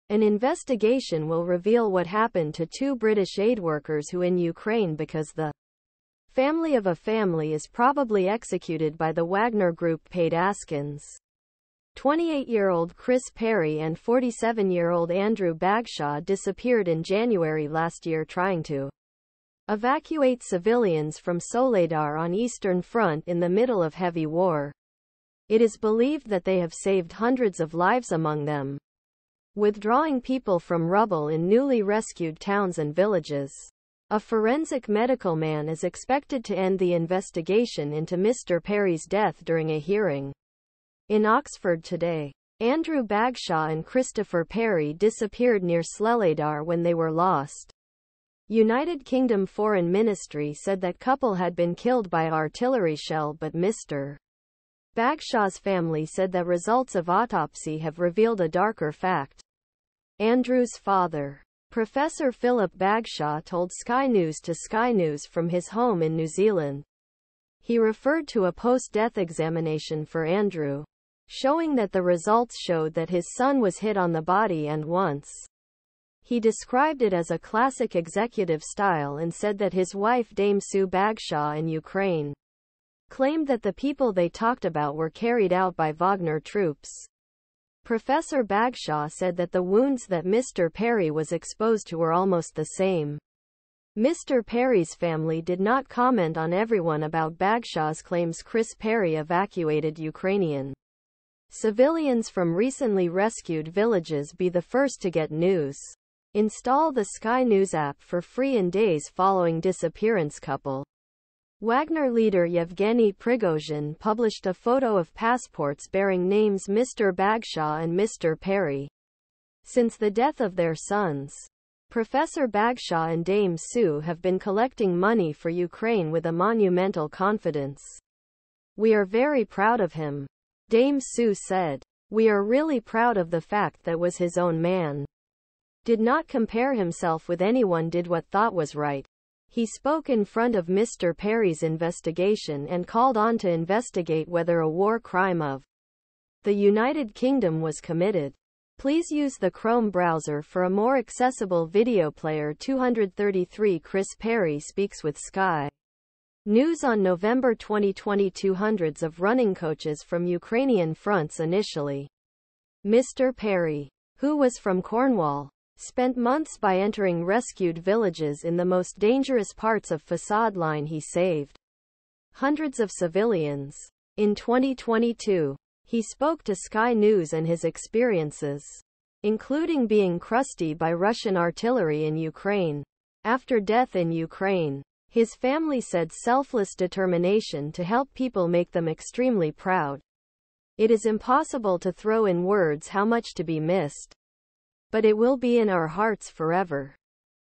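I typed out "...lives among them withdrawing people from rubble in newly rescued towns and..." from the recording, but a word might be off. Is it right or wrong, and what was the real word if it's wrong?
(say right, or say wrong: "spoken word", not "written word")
right.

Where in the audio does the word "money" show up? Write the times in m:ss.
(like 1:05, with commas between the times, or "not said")
2:04.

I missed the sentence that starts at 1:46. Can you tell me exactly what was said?
Install the Sky News app for free in days following disappearance couple.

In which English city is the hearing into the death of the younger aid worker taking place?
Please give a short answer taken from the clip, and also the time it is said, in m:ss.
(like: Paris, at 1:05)
Oxford, at 0:41.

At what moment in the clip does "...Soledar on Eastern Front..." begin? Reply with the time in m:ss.
0:21.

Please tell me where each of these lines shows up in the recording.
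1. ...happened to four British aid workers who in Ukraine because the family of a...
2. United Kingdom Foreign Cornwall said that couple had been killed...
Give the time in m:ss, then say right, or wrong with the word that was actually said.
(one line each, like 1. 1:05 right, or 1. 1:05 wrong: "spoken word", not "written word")
1. 0:02 wrong: "two", not "four"
2. 0:48 wrong: "Ministry", not "Cornwall".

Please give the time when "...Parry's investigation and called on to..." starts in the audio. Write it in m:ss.
2:21.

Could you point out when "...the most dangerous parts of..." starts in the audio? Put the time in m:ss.
2:48.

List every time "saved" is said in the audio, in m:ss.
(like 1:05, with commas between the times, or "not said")
0:26, 2:51.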